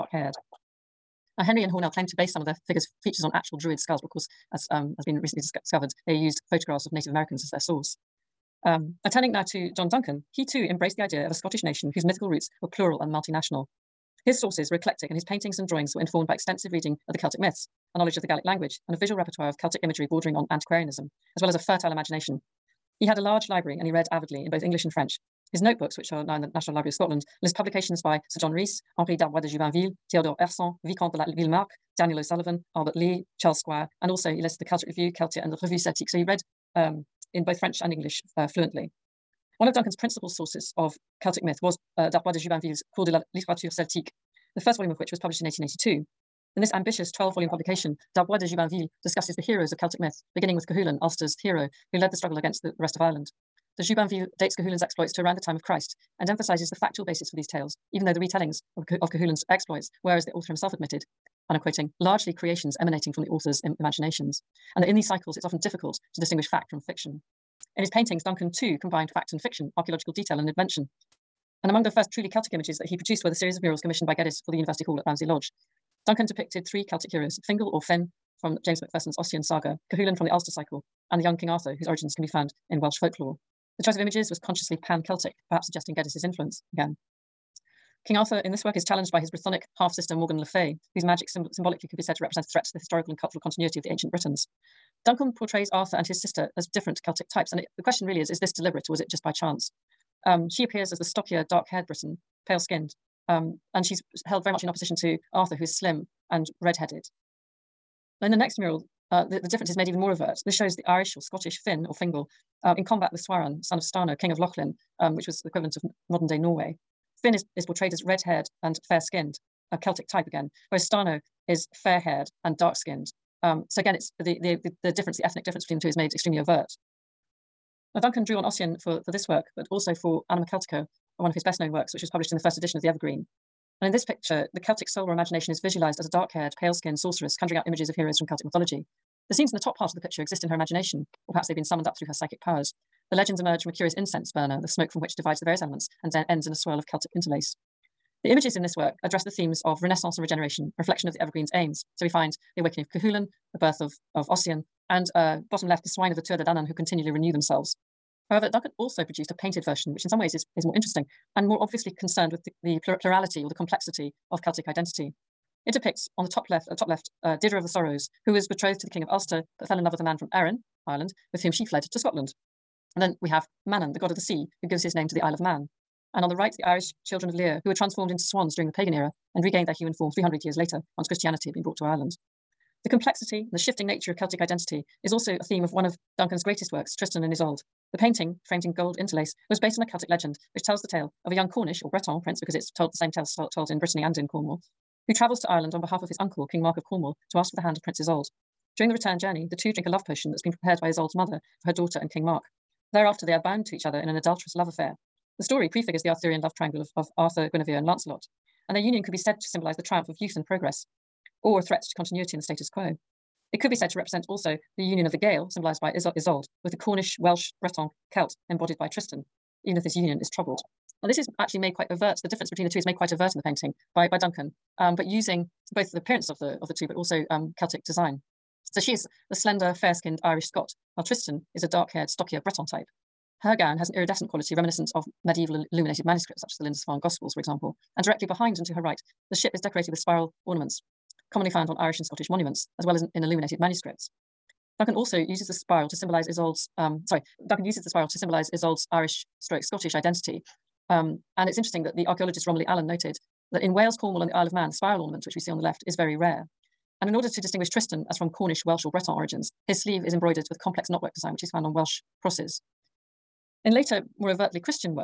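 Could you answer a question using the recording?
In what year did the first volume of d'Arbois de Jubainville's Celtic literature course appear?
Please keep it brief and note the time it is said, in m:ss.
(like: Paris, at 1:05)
1882, at 0:45.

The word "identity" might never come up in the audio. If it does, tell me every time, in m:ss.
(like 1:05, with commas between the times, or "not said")
2:44, 3:04, 4:09.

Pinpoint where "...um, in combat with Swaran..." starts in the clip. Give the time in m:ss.
1:52.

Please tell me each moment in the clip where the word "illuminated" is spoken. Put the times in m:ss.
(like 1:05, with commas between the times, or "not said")
3:55, 4:03.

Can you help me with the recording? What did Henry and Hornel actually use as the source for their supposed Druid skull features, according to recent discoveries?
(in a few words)
Photographs of Native Americans.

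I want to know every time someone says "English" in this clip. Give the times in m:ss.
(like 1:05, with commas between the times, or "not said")
0:24, 0:37.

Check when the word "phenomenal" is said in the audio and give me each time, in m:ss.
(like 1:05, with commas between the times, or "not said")
not said.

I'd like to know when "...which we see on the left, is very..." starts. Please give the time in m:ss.
4:15.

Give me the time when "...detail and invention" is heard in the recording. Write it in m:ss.
1:10.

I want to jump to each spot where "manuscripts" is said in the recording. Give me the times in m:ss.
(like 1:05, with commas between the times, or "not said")
3:56, 4:03.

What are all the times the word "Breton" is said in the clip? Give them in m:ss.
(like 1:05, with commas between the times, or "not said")
3:11, 3:37, 3:52, 4:18.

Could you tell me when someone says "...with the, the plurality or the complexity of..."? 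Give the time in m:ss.
2:42.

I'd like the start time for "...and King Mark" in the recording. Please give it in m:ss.
3:21.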